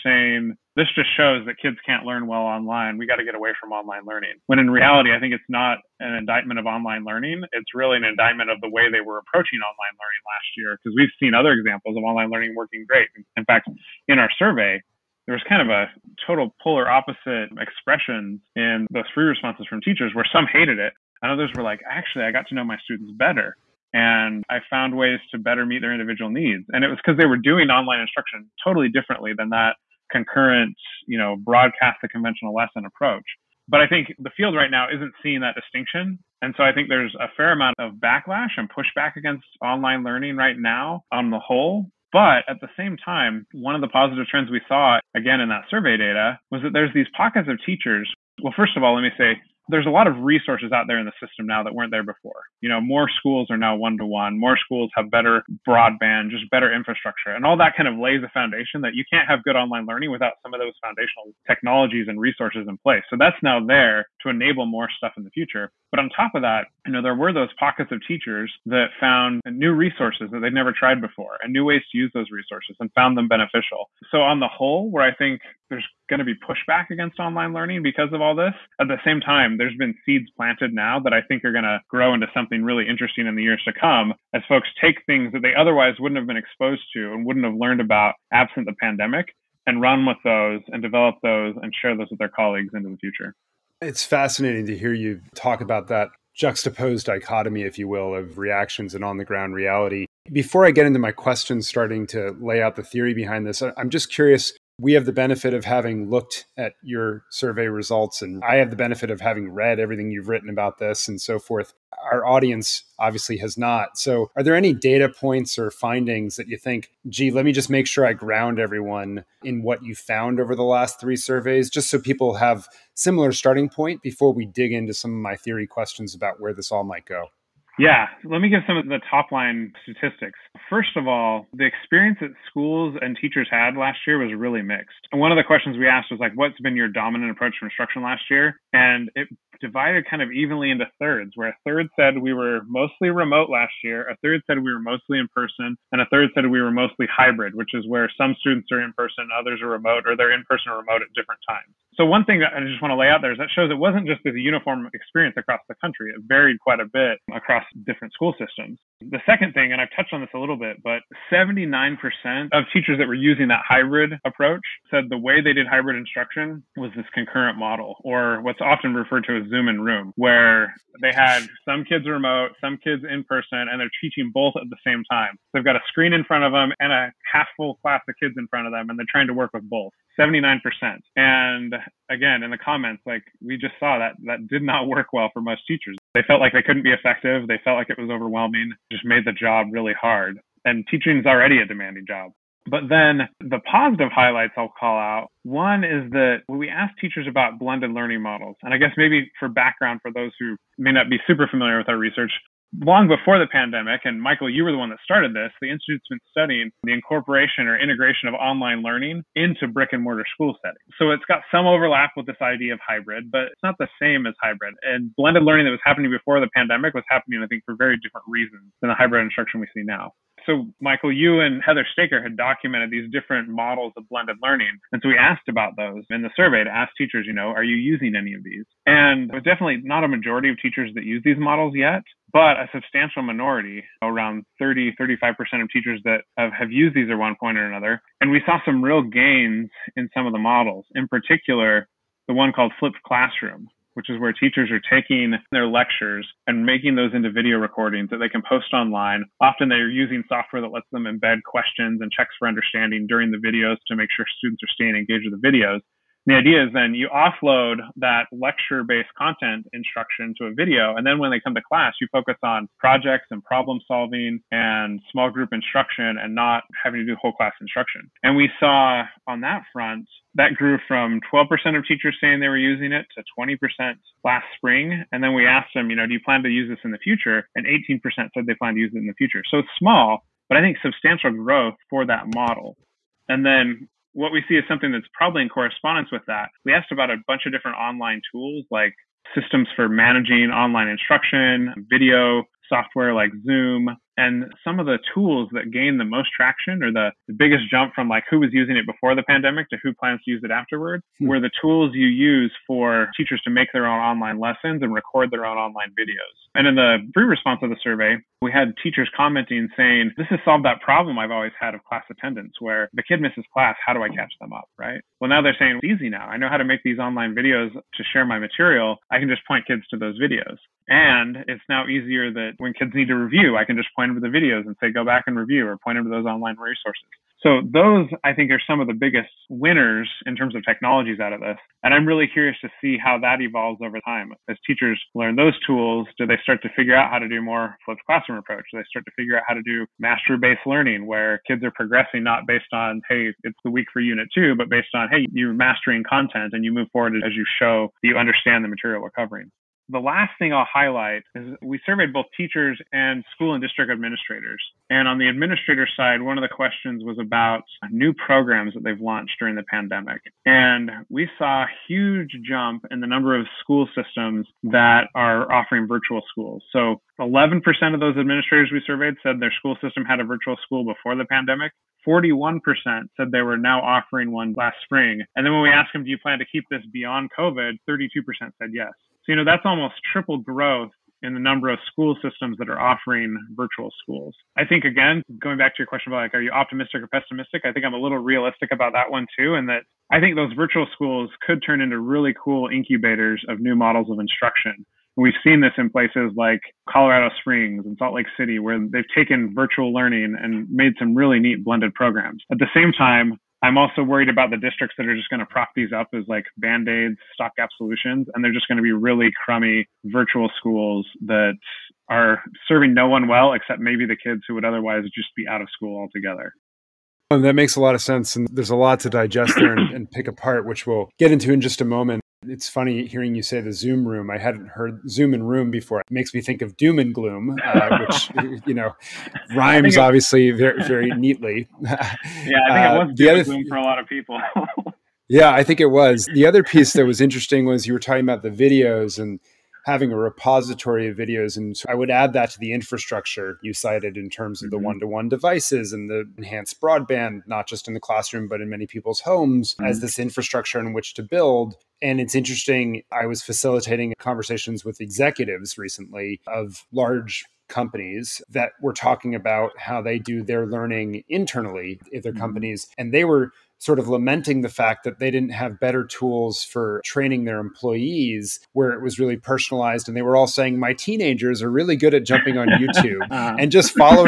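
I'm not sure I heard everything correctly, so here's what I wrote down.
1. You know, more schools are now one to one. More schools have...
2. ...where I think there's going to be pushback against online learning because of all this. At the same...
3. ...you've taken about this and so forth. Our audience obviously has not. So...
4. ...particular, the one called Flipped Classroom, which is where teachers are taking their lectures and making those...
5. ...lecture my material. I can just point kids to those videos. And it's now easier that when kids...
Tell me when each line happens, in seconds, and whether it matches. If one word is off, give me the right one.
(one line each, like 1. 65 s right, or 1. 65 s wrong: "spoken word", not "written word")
1. 52 s right
2. 74 s right
3. 110 s wrong: "written", not "taken"
4. 241 s right
5. 318 s wrong: "share", not "lecture".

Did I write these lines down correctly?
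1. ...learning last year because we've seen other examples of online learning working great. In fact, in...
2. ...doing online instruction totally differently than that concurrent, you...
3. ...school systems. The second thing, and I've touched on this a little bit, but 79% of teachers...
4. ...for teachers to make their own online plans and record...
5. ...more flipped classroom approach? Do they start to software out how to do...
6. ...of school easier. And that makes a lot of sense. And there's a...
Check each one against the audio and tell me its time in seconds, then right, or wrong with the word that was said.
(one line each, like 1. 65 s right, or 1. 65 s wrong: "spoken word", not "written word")
1. 9 s right
2. 27 s right
3. 158 s right
4. 302 s wrong: "lessons", not "plans"
5. 337 s wrong: "figure", not "software"
6. 415 s wrong: "altogether", not "easier".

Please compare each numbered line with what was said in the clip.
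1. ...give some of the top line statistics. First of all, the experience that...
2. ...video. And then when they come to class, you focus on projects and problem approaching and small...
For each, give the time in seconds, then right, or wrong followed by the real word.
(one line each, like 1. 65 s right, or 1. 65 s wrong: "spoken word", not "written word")
1. 128 s right
2. 260 s wrong: "solving", not "approaching".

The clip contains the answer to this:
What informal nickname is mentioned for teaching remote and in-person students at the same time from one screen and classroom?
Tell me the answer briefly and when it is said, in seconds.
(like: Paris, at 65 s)
Zoom in Room, at 169 s.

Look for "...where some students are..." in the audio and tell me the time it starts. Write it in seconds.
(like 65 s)
147 s.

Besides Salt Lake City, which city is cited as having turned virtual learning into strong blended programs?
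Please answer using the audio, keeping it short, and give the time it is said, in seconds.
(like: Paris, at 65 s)
Colorado Springs, at 396 s.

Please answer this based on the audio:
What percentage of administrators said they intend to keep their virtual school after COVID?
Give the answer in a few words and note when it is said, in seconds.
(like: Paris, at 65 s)
32%, at 377 s.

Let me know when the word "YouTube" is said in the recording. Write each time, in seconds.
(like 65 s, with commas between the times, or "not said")
472 s.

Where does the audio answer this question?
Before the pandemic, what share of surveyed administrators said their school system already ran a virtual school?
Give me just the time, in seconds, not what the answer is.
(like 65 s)
367 s.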